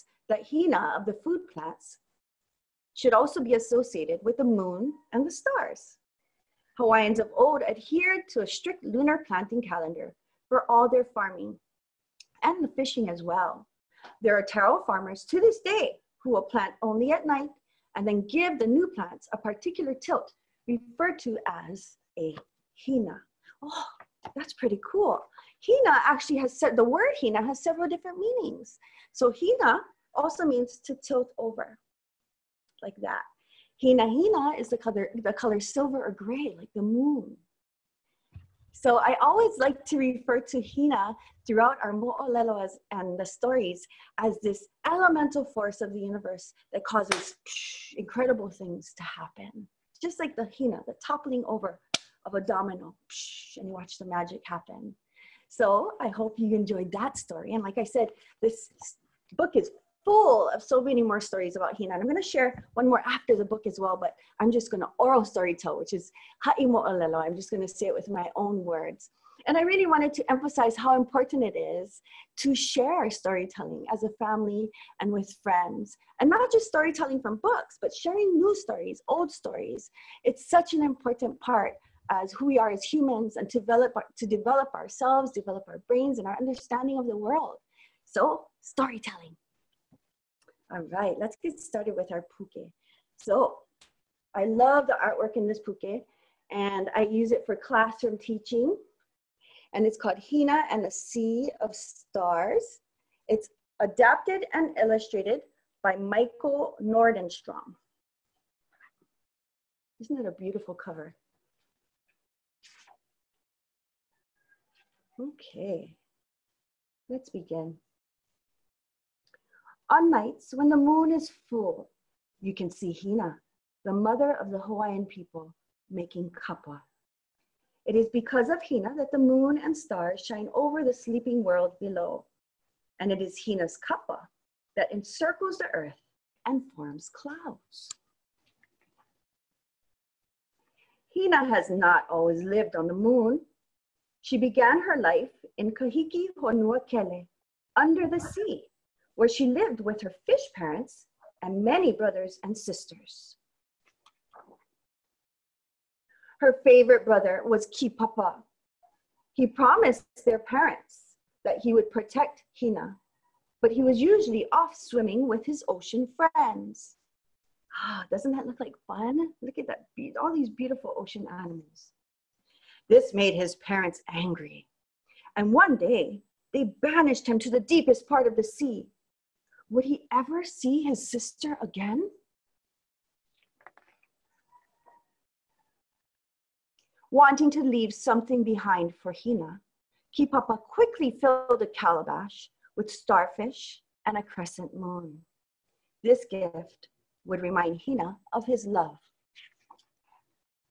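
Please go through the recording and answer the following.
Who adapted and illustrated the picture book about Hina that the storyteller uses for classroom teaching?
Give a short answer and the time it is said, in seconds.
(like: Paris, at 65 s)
Michael Nordenstrom, at 105 s.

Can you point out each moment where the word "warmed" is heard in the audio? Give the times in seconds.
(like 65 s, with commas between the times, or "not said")
not said.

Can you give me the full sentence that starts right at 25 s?
Hina actually has said the word hina has several different meanings.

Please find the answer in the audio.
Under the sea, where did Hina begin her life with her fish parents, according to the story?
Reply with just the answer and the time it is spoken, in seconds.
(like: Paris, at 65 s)
Kahiki Honua Kele, at 145 s.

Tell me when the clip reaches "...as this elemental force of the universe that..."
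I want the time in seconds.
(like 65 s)
44 s.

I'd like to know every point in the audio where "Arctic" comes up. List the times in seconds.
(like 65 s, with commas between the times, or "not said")
not said.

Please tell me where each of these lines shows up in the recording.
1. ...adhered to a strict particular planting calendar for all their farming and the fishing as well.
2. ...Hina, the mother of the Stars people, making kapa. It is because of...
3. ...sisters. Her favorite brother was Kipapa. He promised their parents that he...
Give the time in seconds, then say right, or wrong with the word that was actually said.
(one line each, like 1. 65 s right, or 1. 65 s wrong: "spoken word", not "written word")
1. 7 s wrong: "lunar", not "particular"
2. 122 s wrong: "Hawaiian", not "Stars"
3. 152 s right.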